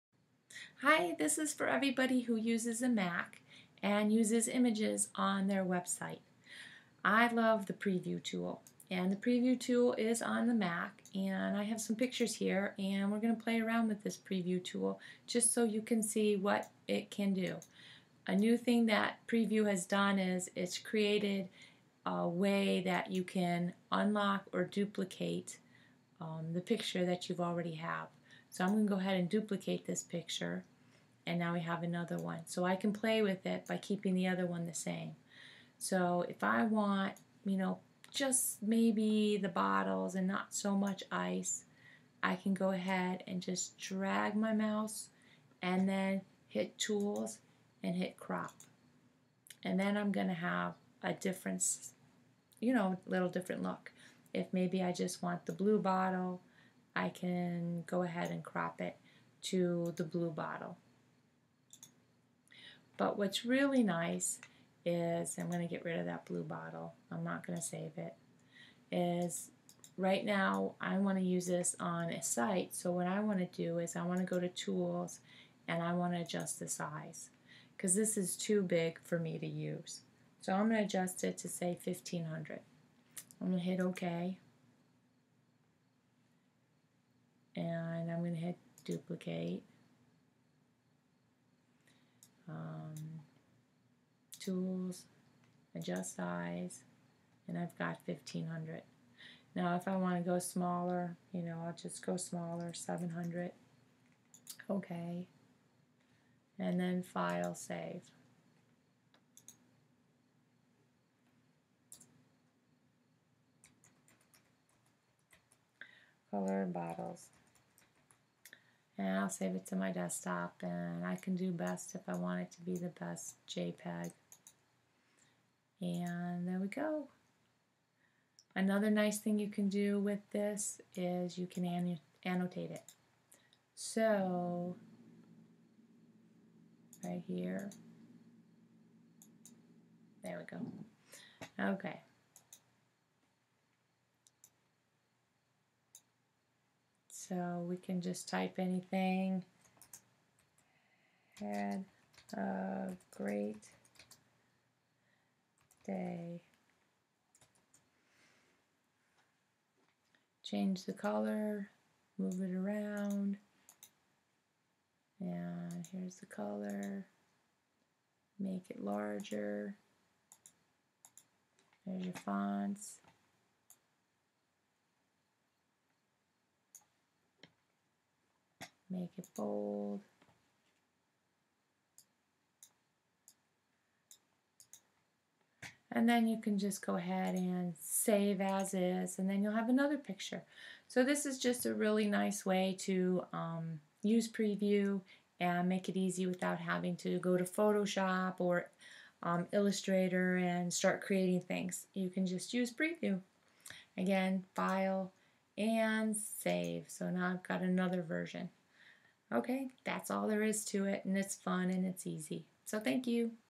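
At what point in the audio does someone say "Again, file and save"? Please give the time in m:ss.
3:23.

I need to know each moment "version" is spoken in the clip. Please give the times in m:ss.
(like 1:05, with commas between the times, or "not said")
3:28.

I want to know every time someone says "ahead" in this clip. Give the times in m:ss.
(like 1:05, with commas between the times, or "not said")
0:28, 0:42, 0:58, 3:06.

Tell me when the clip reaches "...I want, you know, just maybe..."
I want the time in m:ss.
0:36.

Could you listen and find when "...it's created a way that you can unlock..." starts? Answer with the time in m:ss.
0:20.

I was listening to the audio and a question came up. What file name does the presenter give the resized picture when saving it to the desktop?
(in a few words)
color bottles.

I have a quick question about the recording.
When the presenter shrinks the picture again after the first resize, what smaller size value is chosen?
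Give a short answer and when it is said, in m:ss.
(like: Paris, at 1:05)
700, at 1:42.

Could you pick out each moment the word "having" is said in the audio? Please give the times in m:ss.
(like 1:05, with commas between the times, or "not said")
3:16.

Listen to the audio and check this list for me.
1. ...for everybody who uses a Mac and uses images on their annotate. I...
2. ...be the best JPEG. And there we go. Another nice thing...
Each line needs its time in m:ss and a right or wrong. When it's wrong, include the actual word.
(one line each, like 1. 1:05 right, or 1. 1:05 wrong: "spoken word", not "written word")
1. 0:01 wrong: "website", not "annotate"
2. 2:02 right.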